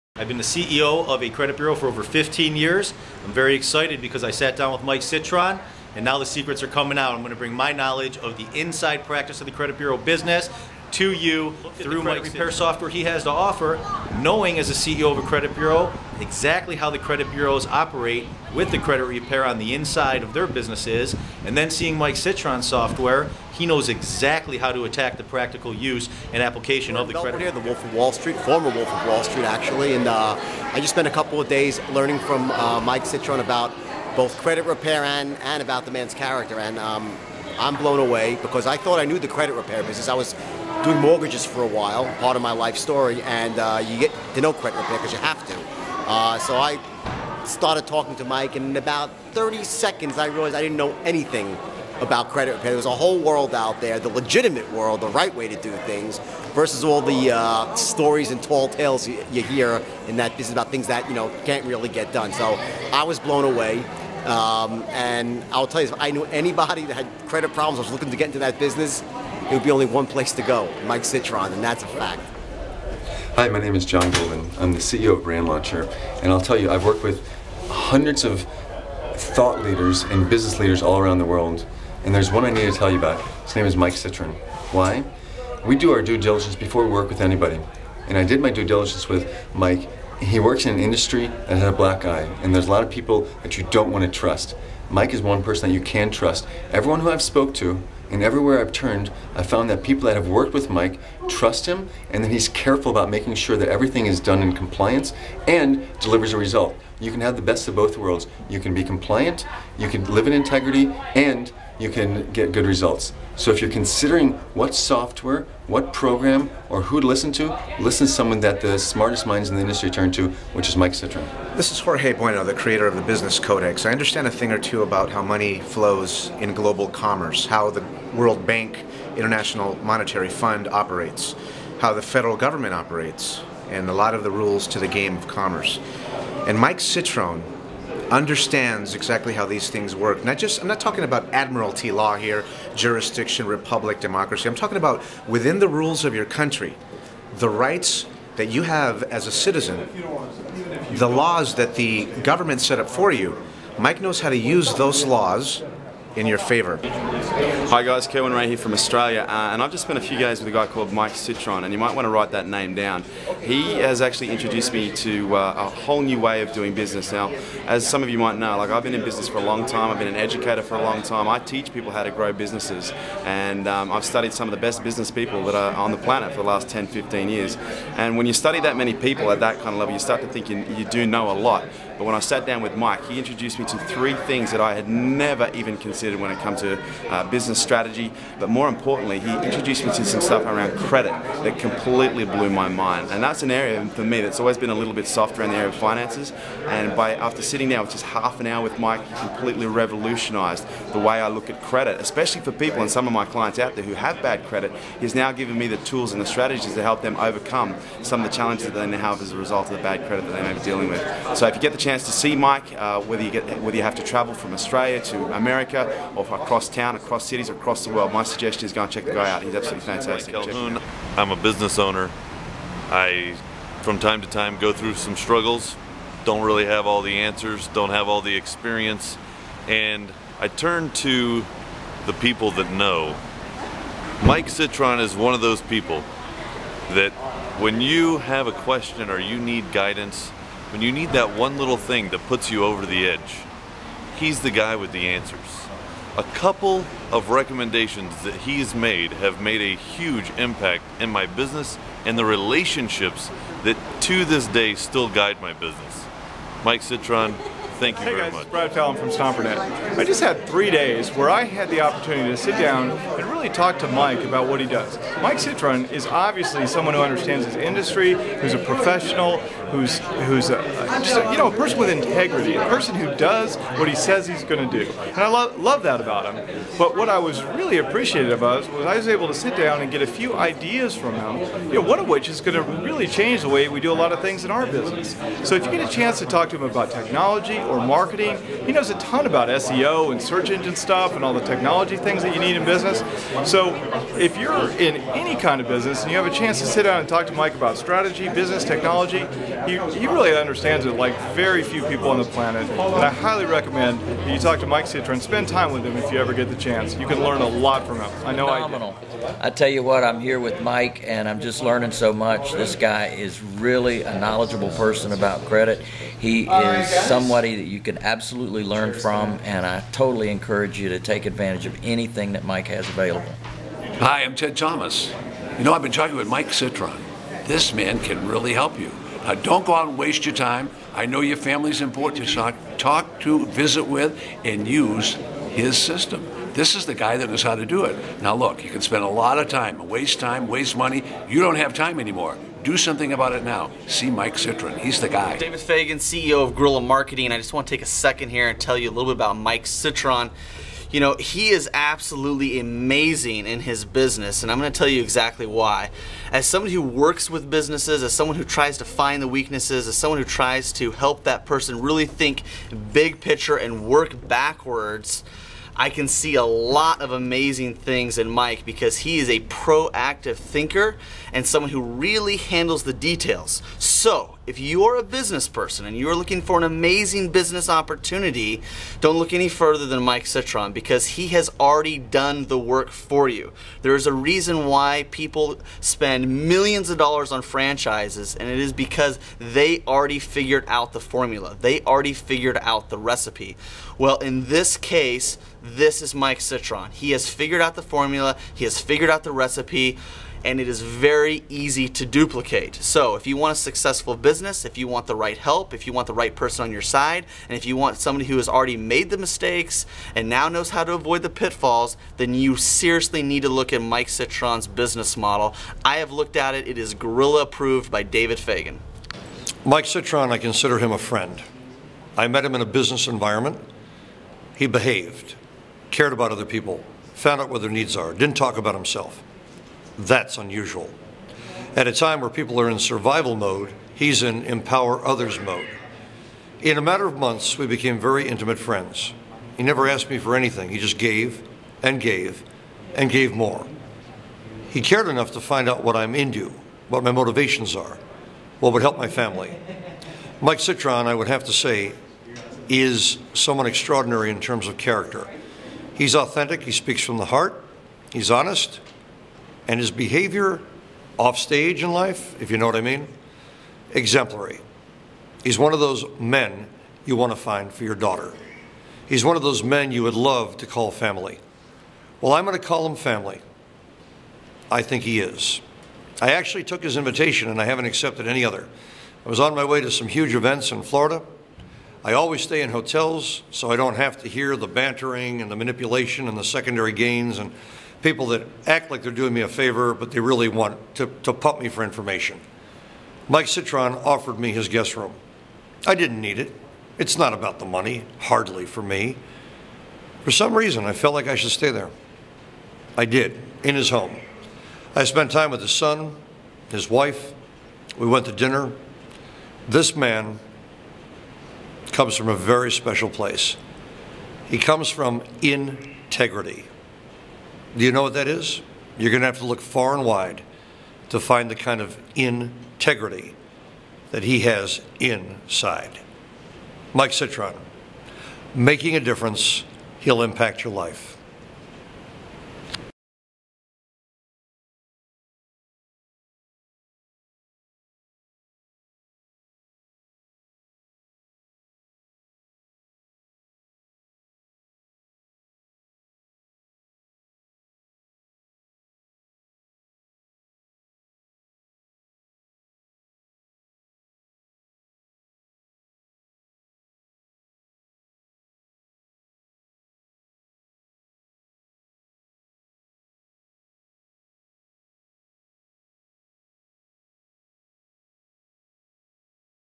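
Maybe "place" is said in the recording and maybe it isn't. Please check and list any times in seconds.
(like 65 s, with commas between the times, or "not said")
70 s, 513 s.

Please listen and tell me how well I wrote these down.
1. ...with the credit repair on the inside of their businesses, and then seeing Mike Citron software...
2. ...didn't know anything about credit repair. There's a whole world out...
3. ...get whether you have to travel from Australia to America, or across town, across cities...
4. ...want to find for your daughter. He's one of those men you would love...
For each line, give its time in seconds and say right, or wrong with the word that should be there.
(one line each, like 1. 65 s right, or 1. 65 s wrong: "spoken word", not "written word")
1. 18 s right
2. 50 s right
3. 213 s right
4. 467 s right.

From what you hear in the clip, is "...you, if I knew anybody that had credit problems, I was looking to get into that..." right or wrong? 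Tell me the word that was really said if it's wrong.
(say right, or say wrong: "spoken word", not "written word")
right.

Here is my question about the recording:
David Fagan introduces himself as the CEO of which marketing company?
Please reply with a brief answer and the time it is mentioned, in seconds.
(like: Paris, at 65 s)
Gorilla Marketing, at 346 s.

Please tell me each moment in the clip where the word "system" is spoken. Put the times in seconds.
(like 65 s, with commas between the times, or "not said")
12 s, 335 s.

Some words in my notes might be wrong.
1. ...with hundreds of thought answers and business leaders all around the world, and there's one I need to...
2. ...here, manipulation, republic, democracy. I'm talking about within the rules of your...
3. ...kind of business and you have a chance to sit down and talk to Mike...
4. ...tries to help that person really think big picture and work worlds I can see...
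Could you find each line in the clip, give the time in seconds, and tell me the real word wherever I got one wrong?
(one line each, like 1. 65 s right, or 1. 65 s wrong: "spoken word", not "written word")
1. 77 s wrong: "leaders", not "answers"
2. 142 s wrong: "jurisdiction", not "manipulation"
3. 295 s right
4. 360 s wrong: "backwards", not "worlds".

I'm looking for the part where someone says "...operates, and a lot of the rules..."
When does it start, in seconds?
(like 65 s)
132 s.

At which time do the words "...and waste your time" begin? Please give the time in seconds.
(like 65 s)
329 s.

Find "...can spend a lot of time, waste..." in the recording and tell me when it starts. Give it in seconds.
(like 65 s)
338 s.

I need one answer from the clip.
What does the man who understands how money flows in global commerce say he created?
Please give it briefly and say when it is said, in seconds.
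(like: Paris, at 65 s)
the Business Codex, at 122 s.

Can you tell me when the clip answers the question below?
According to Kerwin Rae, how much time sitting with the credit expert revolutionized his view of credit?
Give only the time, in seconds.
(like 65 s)
198 s.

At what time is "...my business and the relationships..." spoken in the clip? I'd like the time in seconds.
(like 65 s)
251 s.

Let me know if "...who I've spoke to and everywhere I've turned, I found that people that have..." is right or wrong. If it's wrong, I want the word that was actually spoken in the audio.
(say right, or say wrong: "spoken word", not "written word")
right.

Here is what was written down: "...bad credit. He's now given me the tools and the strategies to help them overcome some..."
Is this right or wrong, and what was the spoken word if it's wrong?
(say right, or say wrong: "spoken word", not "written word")
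right.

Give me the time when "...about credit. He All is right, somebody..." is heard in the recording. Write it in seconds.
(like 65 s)
315 s.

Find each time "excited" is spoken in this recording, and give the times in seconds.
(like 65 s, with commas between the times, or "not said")
3 s.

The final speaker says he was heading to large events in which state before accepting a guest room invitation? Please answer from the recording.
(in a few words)
Florida.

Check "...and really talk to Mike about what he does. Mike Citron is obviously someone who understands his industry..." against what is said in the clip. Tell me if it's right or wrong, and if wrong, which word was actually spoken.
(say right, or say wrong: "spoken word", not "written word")
right.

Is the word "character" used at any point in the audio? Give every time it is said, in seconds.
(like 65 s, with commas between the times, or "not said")
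36 s, 454 s.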